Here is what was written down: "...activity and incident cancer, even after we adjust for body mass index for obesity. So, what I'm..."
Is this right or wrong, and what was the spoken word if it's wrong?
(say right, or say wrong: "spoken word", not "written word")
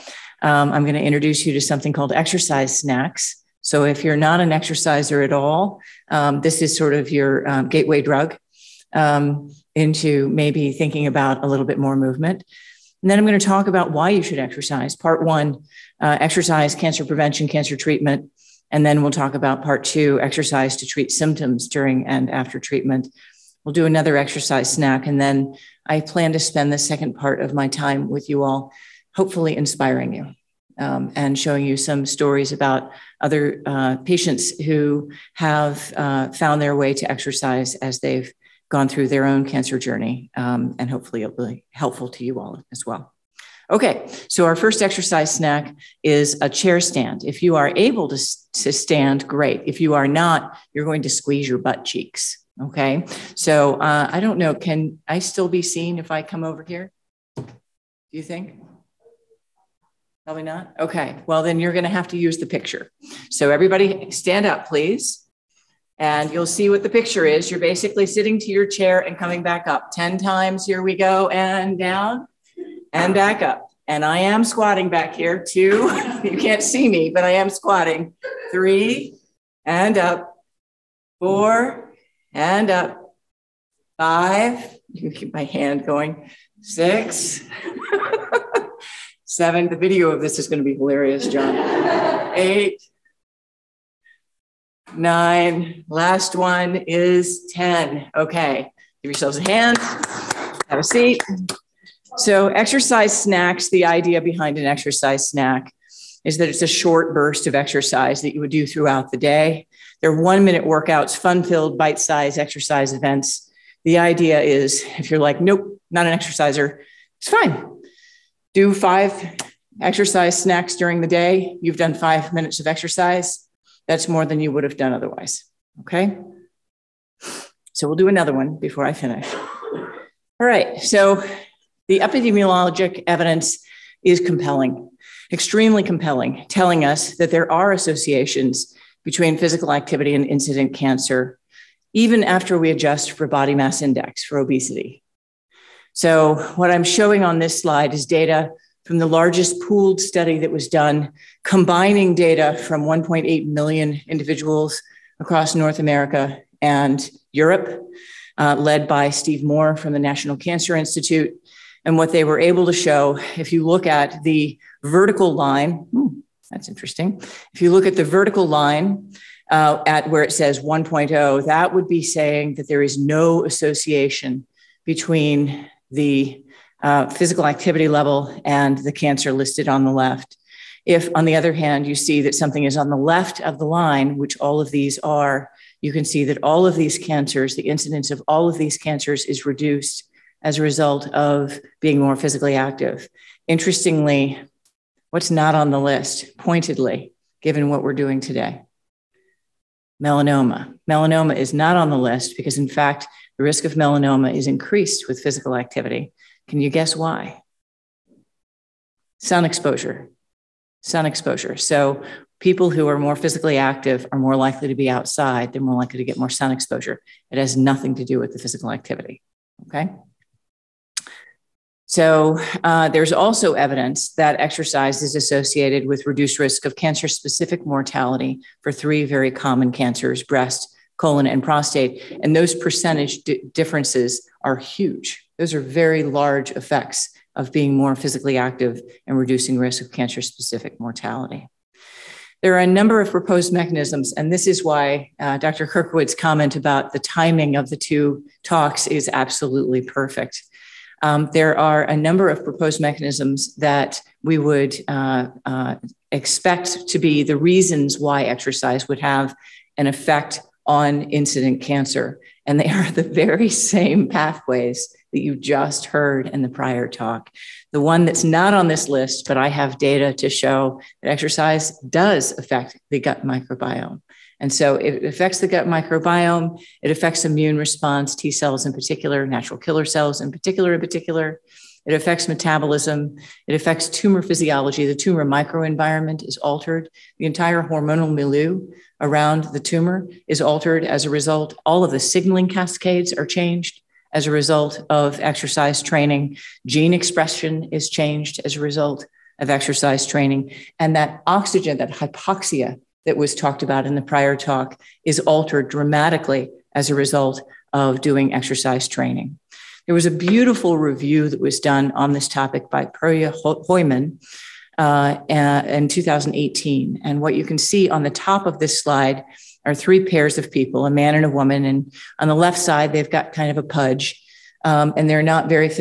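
right.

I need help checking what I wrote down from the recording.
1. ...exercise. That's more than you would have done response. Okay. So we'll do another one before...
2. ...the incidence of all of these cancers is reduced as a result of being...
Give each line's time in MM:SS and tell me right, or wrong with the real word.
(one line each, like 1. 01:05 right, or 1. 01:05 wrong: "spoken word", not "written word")
1. 02:02 wrong: "otherwise", not "response"
2. 03:07 right.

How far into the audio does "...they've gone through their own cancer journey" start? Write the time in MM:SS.
00:37.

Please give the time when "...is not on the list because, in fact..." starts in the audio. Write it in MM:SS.
03:21.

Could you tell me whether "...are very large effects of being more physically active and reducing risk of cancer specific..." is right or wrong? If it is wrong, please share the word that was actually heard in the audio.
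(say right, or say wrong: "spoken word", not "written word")
right.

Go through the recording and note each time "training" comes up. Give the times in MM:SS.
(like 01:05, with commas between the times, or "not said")
04:55, 05:00, 05:08.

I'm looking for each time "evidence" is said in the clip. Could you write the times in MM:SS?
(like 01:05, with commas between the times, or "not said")
02:13, 03:43.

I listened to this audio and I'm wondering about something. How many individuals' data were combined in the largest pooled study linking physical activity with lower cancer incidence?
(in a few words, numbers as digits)
1.8 million.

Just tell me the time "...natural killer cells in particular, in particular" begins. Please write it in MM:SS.
04:39.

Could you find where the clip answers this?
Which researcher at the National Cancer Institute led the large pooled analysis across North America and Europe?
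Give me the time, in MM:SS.
02:39.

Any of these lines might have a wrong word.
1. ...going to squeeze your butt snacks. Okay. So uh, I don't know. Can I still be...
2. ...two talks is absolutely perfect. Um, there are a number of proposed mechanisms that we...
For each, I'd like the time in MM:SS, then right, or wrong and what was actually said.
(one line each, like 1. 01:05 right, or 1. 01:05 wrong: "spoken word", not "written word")
1. 00:50 wrong: "cheeks", not "snacks"
2. 04:07 right.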